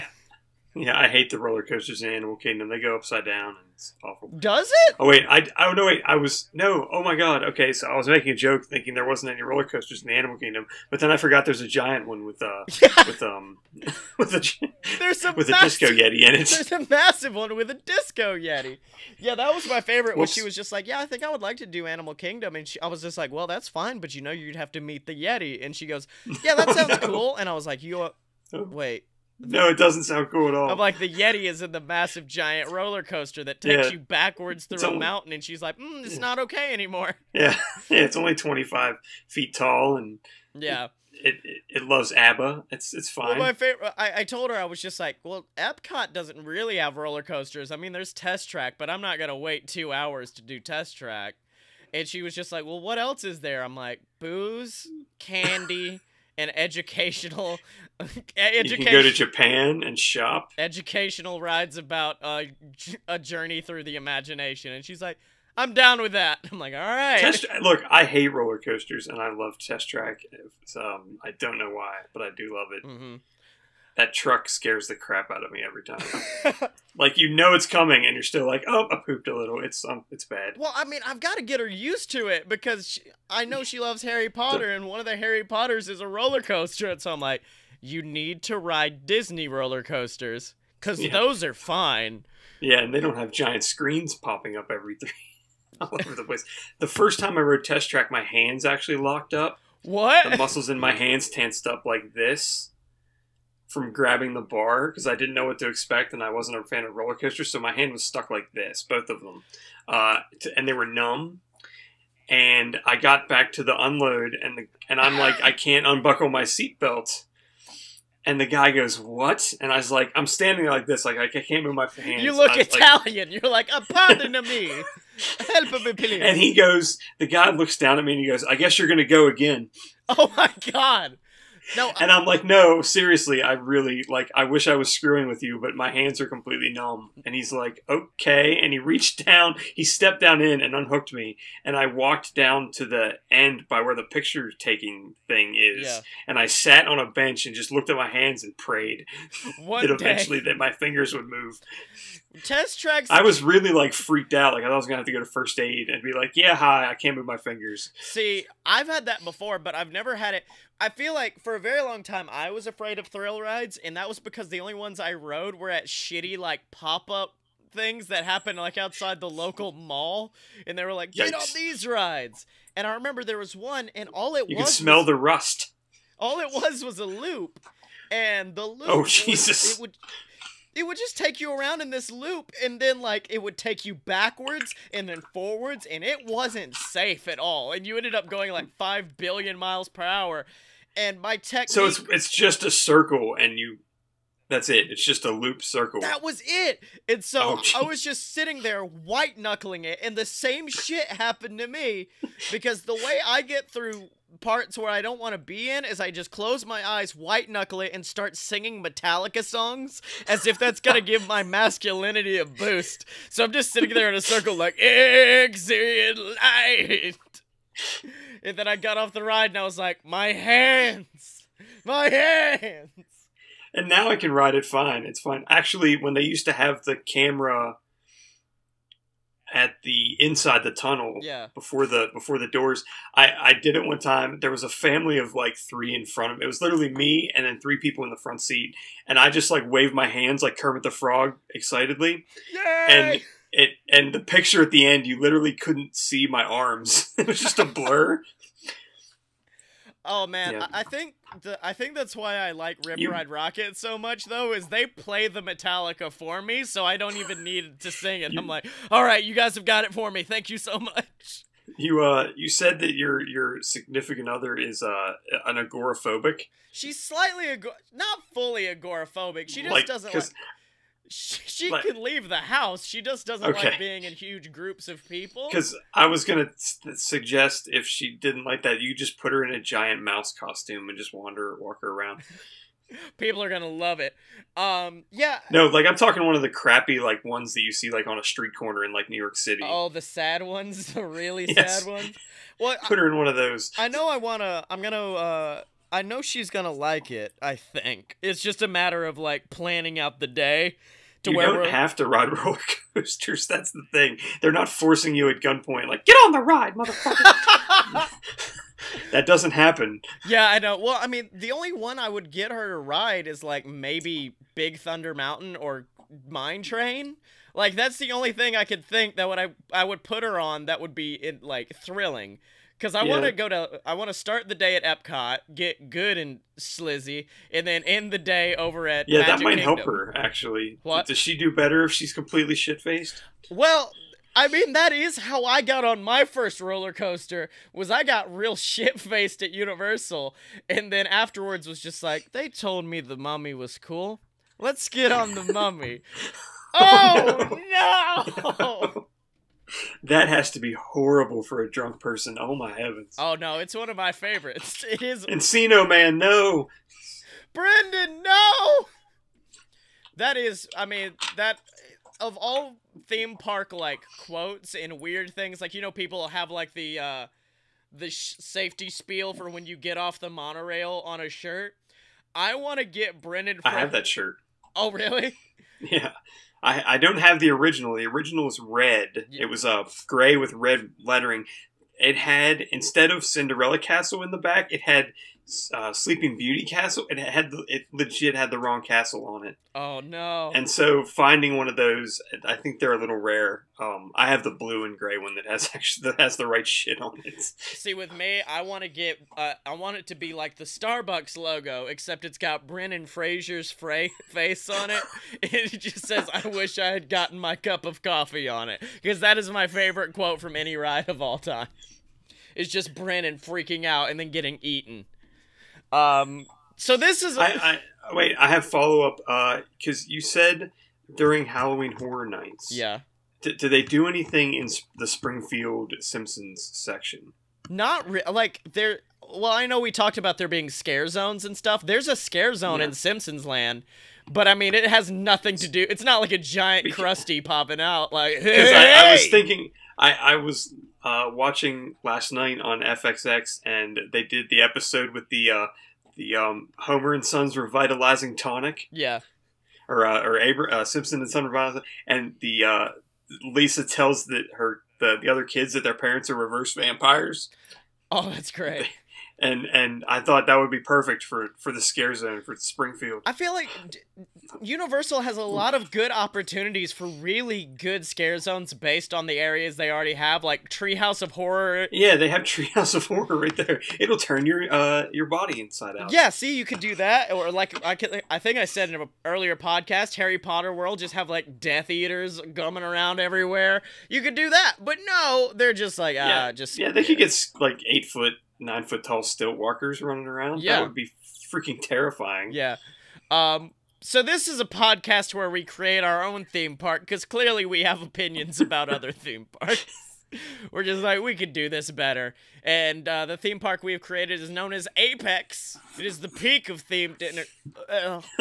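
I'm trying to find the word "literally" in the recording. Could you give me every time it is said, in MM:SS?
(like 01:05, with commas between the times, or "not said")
03:56, 04:05.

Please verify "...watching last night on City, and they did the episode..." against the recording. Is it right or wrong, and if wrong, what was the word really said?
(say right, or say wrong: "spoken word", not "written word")
wrong: "FXX", not "City".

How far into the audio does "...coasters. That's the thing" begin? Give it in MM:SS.
05:02.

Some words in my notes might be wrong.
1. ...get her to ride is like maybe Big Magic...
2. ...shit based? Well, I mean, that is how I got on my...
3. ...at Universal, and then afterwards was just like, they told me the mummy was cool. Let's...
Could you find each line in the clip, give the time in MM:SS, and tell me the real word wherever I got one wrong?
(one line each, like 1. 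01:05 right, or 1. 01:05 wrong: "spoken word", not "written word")
1. 05:12 wrong: "Thunder", not "Magic"
2. 05:32 wrong: "faced", not "based"
3. 05:39 right.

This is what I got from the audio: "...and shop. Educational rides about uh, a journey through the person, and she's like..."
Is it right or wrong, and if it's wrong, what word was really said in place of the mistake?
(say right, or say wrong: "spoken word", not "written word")
wrong: "imagination", not "person".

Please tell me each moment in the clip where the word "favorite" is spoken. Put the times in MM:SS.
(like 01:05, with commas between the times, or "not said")
00:19, 00:43, 05:54, 06:49.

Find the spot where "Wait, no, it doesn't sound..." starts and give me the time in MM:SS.
00:28.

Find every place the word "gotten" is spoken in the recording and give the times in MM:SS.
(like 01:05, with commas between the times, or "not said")
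06:47.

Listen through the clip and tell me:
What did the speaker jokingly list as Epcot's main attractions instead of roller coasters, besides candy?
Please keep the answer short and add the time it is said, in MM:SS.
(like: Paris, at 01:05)
booze, at 00:54.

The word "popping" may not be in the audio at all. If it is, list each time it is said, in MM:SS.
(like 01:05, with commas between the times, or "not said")
01:34, 07:17.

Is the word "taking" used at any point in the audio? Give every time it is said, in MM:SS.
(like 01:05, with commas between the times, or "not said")
02:24.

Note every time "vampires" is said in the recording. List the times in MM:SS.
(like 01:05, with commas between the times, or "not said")
07:36.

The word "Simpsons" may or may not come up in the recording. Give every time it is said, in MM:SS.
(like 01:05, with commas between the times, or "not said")
07:06, 07:12, 07:30.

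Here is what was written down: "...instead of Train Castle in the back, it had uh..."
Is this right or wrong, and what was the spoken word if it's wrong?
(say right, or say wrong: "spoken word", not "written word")
wrong: "Cinderella", not "Train".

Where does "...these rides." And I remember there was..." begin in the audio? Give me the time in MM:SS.
02:51.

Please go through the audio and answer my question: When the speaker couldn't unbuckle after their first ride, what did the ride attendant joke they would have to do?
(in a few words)
go again.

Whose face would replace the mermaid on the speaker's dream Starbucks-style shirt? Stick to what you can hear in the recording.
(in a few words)
Brendan Fraser.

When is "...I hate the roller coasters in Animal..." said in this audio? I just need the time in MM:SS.
00:00.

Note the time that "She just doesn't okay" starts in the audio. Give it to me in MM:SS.
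04:32.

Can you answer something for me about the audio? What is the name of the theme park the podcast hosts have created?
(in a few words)
Apex.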